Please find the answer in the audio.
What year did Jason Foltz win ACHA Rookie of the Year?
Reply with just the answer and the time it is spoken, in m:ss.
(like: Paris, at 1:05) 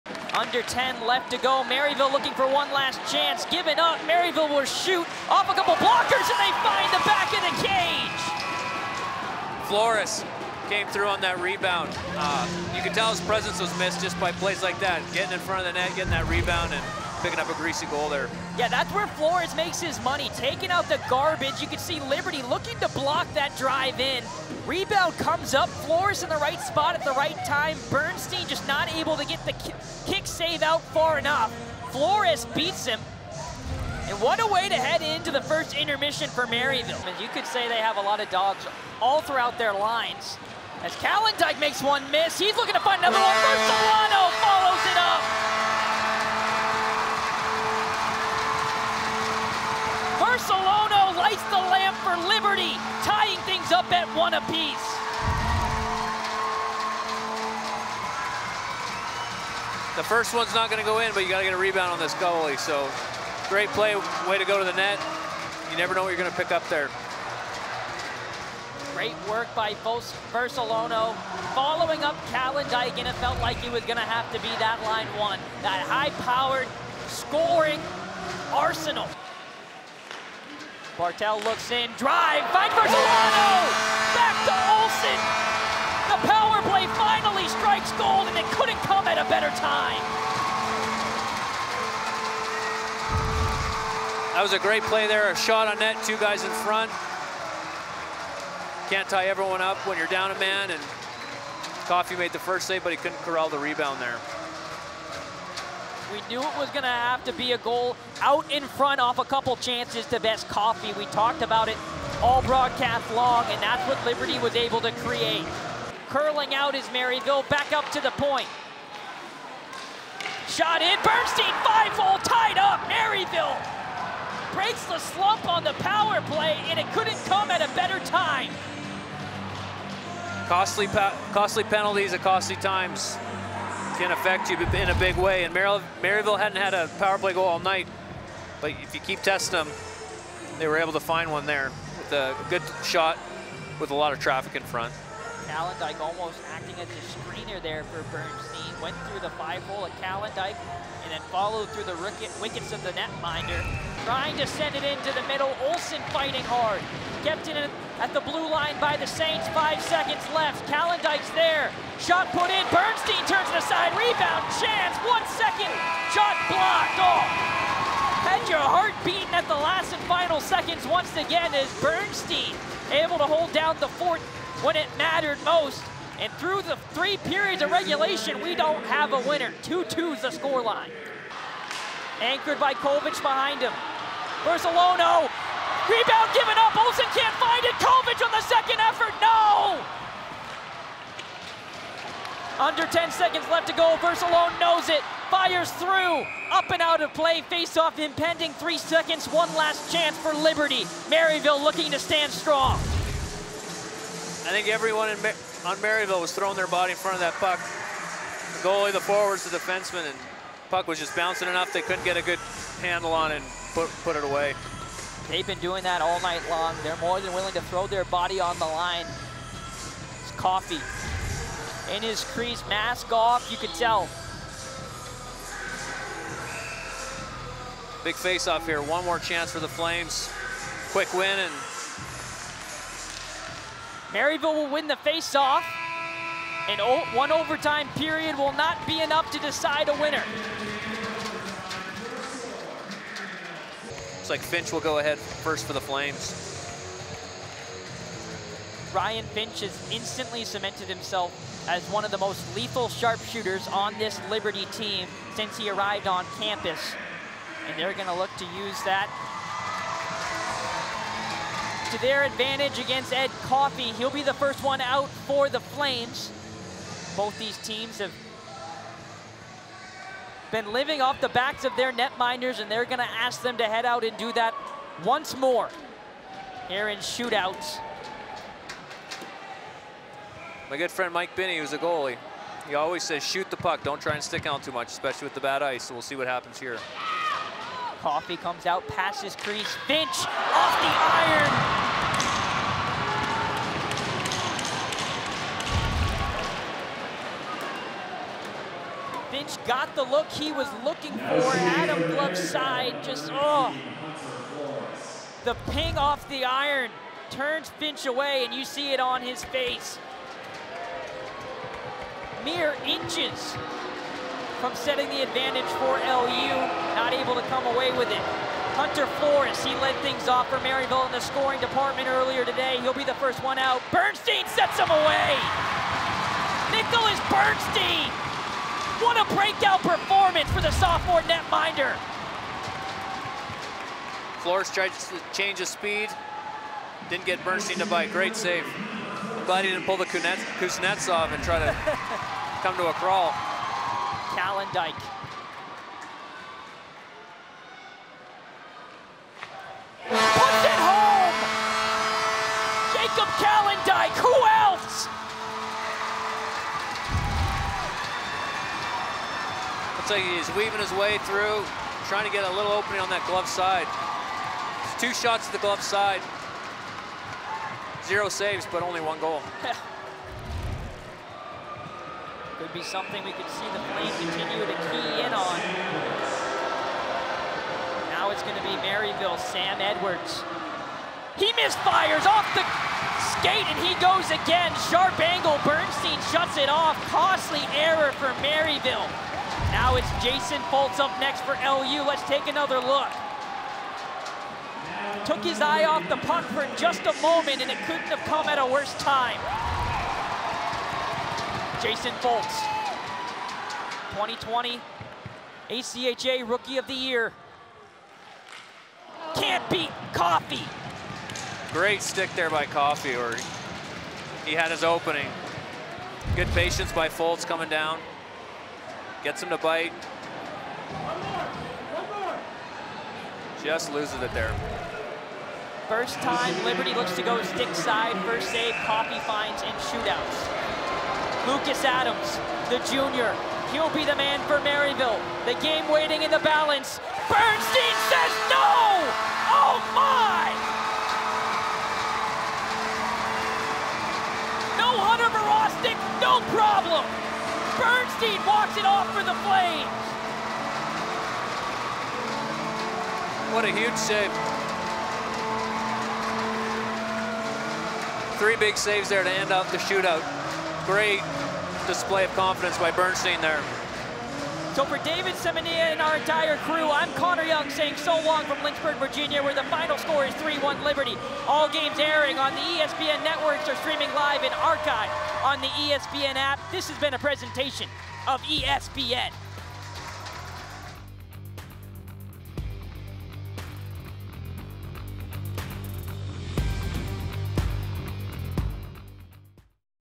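2020, at 6:44.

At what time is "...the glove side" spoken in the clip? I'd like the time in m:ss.
6:05.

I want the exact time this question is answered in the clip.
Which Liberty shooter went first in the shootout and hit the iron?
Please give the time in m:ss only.
4:08.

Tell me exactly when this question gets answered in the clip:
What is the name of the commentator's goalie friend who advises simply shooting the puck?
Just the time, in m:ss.
4:41.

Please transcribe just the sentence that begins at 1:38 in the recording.
Can't tie everyone up when you're down a man and Coffey made the first save, but he couldn't corral the rebound there.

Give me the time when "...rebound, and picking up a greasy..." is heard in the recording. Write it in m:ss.
0:16.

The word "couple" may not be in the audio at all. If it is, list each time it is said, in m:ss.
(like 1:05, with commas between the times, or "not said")
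0:05, 1:49.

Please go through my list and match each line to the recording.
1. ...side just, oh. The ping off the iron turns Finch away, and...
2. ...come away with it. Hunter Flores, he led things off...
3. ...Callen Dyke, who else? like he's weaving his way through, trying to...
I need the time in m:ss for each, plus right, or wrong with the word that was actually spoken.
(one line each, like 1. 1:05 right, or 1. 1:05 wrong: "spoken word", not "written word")
1. 5:02 right
2. 5:17 right
3. 5:53 right.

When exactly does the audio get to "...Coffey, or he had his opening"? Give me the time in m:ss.
6:52.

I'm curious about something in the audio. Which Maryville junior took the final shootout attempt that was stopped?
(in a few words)
Lucas Adams.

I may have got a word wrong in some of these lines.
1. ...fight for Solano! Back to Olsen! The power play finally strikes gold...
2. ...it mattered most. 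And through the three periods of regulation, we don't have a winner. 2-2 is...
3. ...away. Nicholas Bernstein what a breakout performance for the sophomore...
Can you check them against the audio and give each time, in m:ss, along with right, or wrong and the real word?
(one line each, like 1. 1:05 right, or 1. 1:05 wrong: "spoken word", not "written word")
1. 1:22 right
2. 2:54 right
3. 5:24 right.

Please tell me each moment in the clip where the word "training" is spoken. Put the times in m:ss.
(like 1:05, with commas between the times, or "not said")
not said.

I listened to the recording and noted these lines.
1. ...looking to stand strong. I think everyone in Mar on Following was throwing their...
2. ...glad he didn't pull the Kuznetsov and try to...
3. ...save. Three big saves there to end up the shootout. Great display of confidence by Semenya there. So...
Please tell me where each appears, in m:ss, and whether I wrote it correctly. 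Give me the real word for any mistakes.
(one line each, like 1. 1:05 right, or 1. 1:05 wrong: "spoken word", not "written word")
1. 3:21 wrong: "Maryville", not "Following"
2. 5:39 right
3. 7:33 wrong: "Bernstein", not "Semenya".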